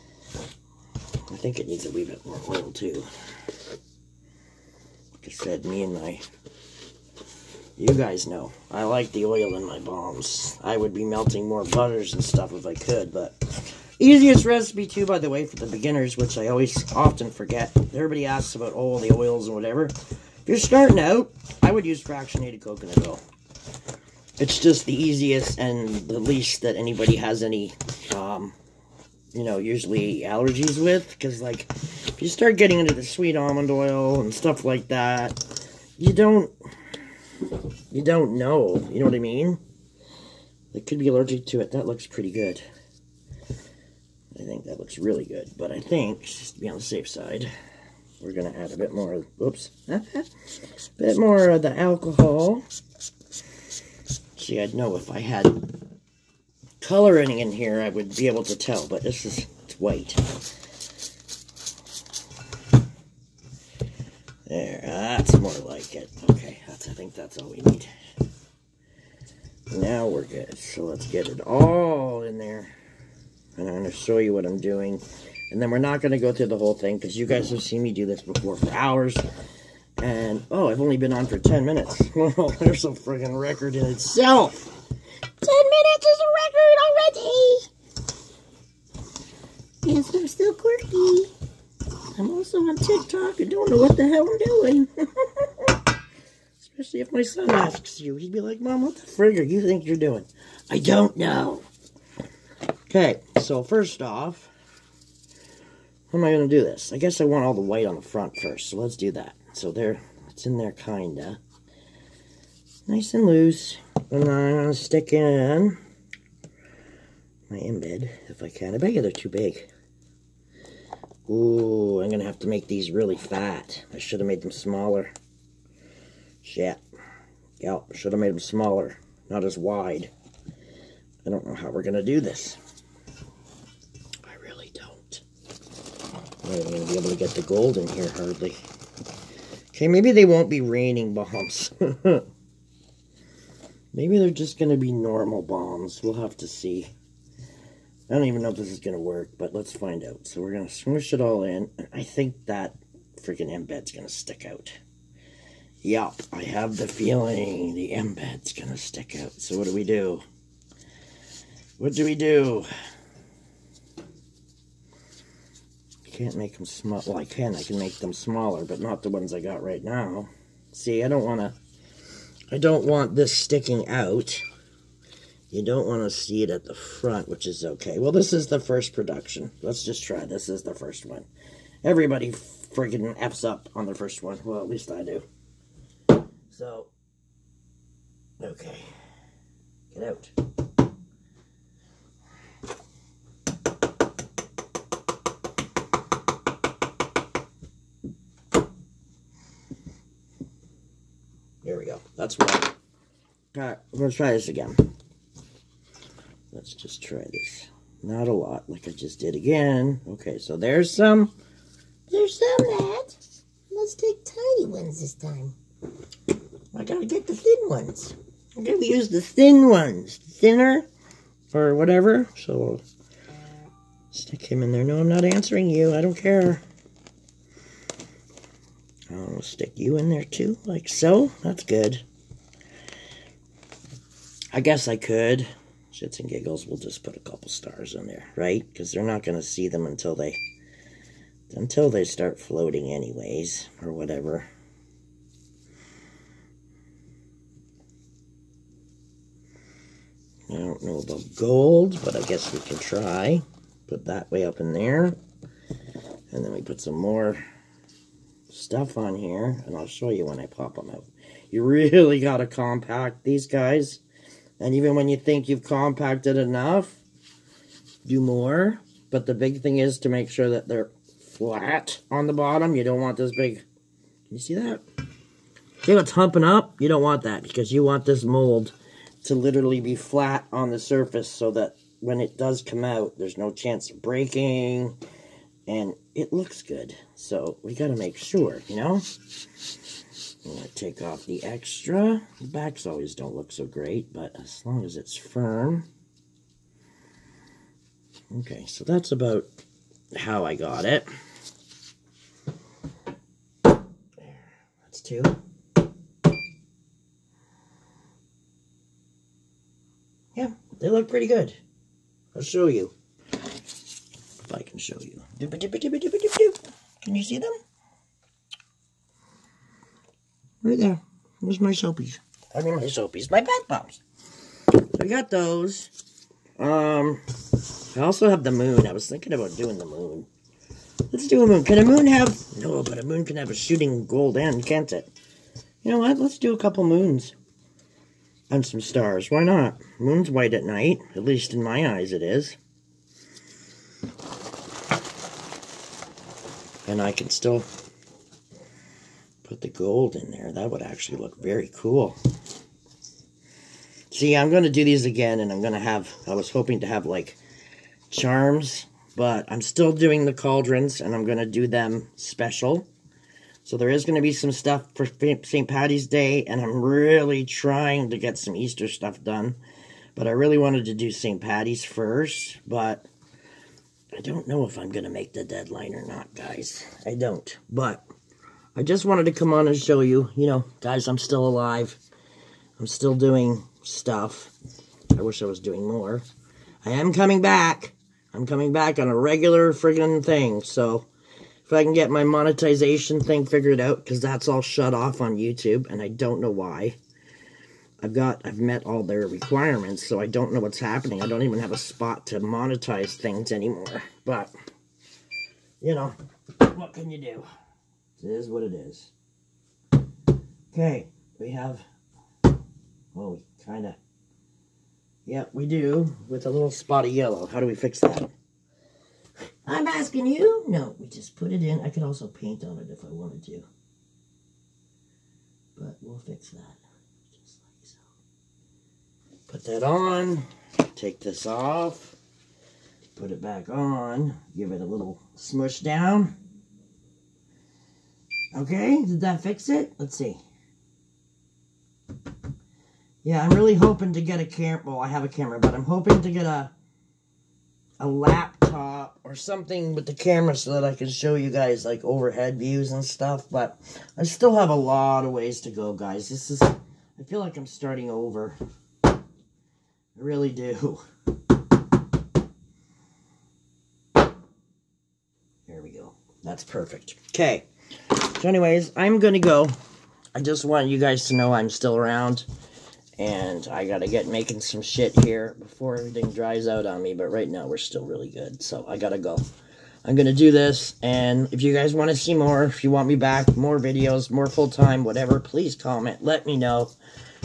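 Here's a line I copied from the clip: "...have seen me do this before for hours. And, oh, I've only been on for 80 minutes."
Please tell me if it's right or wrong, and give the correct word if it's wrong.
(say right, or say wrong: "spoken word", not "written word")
wrong: "10", not "80".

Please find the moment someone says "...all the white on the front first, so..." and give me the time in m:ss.
1:47.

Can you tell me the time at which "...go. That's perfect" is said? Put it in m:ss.
7:45.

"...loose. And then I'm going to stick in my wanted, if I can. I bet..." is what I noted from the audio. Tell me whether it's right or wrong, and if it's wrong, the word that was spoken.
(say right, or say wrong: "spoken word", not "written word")
wrong: "embed", not "wanted".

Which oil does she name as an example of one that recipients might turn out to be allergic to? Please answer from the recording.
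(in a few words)
Sweet almond oil.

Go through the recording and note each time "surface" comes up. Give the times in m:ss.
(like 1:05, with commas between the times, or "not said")
4:40.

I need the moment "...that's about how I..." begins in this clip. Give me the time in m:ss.
4:58.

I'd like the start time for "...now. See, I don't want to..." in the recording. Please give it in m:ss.
2:49.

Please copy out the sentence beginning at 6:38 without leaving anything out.
I've got, I've met all their requirements, so I don't know what's happening.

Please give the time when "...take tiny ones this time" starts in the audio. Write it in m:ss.
3:33.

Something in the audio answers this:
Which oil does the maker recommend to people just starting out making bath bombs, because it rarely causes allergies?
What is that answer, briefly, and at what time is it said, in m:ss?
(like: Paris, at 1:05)
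Fractionated coconut oil, at 0:22.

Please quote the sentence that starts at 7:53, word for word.
And I gotta get making some shit here before everything dries out on me.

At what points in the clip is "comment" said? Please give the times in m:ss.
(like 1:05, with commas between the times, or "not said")
8:05.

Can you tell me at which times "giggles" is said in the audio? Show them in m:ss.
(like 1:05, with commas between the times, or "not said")
3:56.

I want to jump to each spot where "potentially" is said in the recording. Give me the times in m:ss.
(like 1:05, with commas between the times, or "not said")
not said.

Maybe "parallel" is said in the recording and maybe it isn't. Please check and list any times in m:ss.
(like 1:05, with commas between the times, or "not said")
not said.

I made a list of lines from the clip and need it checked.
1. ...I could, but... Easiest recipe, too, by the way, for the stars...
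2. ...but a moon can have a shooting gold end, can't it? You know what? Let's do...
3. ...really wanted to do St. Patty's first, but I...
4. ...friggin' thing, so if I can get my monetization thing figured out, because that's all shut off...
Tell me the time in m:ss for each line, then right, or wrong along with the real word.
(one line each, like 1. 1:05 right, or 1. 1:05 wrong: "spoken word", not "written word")
1. 0:12 wrong: "beginners", not "stars"
2. 5:32 right
3. 6:10 right
4. 6:29 right.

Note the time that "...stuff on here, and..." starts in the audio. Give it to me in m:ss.
4:18.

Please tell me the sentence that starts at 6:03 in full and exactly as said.
So there is going to be some stuff for St.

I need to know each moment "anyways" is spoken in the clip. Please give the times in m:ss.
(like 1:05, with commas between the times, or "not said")
4:02, 7:48.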